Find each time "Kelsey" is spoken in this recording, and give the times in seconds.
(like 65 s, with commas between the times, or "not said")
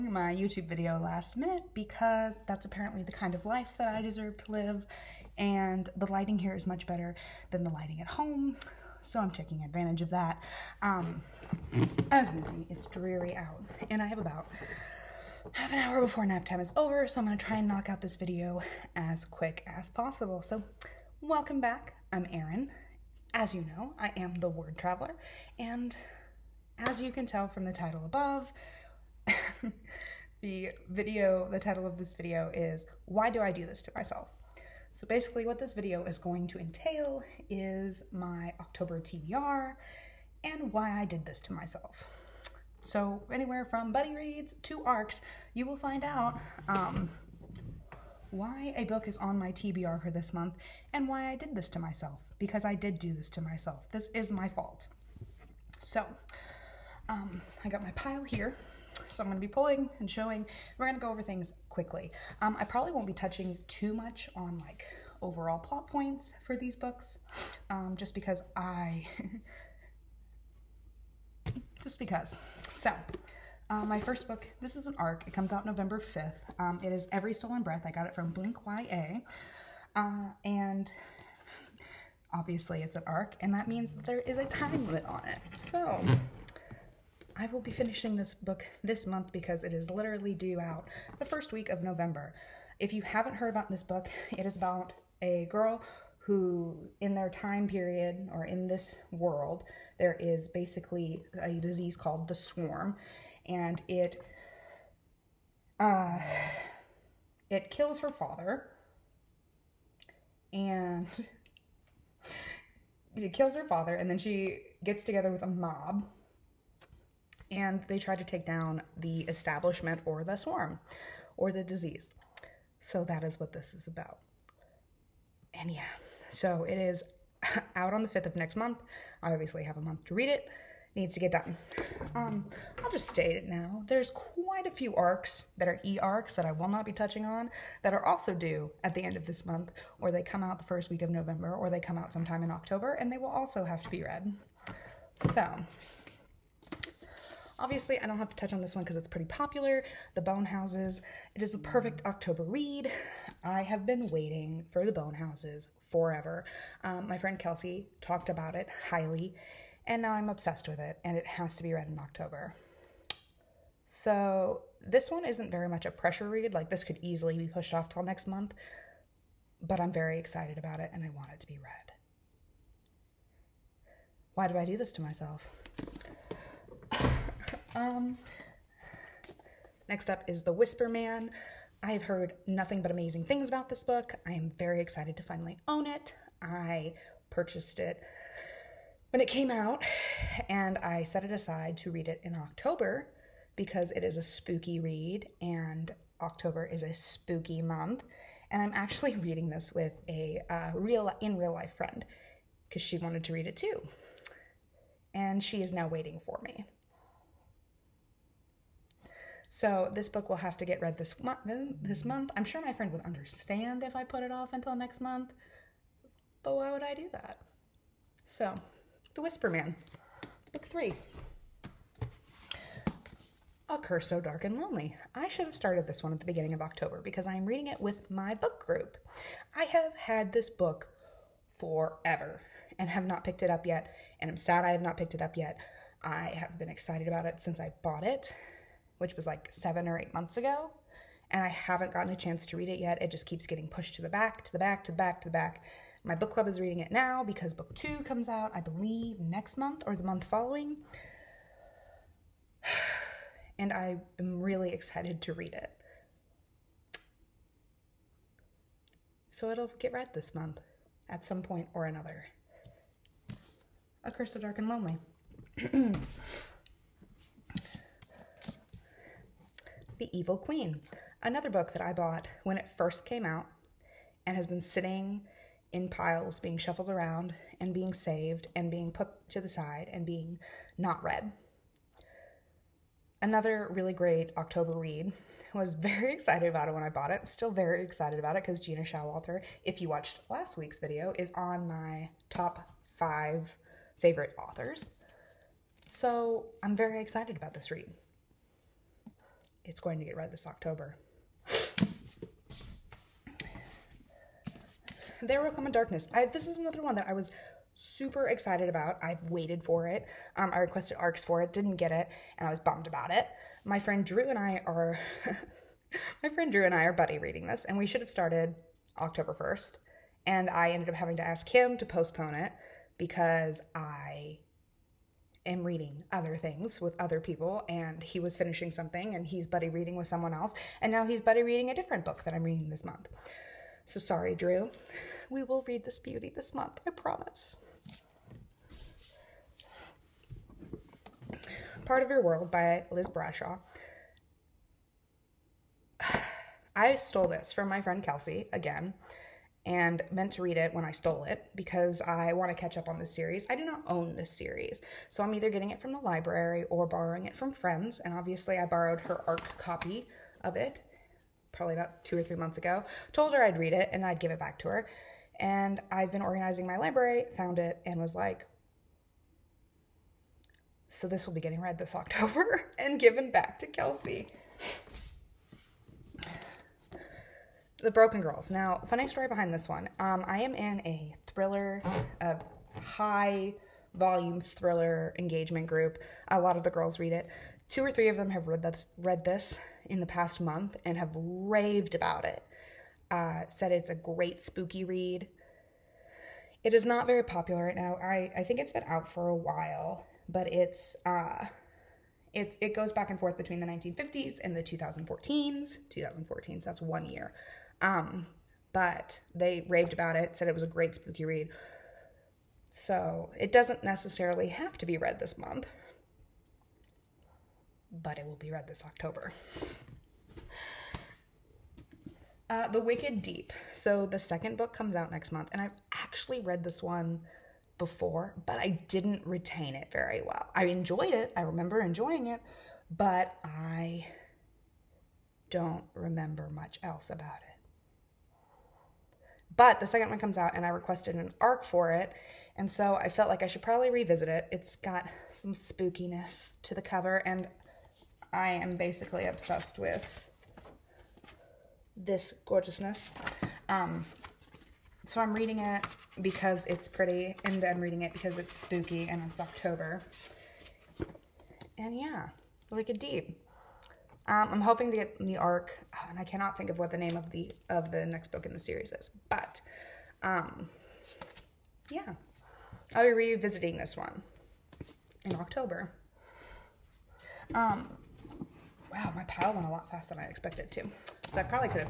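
157 s, 348 s, 373 s.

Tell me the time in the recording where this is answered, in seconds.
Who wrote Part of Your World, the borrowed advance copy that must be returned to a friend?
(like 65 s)
342 s.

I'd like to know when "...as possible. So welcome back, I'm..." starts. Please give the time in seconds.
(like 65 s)
19 s.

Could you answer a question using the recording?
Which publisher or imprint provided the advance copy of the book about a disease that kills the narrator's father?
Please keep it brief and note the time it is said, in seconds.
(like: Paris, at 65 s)
Blink YA, at 78 s.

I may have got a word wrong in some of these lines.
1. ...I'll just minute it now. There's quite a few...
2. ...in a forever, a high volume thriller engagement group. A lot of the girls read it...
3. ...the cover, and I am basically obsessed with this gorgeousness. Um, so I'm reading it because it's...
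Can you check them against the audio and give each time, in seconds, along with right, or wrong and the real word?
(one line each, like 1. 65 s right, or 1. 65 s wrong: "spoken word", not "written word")
1. 132 s wrong: "state", not "minute"
2. 380 s wrong: "thriller", not "forever"
3. 446 s right.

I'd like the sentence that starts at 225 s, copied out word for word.
I should have started this one at the beginning of October because I am reading it with my book group.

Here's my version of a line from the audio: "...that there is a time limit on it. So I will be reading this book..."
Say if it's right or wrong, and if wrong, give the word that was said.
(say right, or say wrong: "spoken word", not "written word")
wrong: "finishing", not "reading".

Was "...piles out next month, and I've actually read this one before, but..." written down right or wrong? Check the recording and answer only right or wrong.
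wrong.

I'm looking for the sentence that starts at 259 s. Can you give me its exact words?
So it'll get read this month at some point or another.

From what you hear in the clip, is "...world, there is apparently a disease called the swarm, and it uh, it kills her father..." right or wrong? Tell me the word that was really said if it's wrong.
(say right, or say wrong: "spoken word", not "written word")
wrong: "basically", not "apparently".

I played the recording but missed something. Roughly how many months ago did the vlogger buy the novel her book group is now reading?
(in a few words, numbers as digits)
7 or 8.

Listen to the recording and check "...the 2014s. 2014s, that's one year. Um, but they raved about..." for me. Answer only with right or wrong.
right.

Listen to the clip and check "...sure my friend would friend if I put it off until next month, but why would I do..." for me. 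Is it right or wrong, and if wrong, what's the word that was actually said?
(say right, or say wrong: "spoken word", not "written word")
wrong: "understand", not "friend".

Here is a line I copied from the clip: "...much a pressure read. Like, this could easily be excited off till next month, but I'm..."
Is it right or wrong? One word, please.
wrong.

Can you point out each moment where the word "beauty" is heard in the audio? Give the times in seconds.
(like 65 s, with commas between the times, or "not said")
335 s.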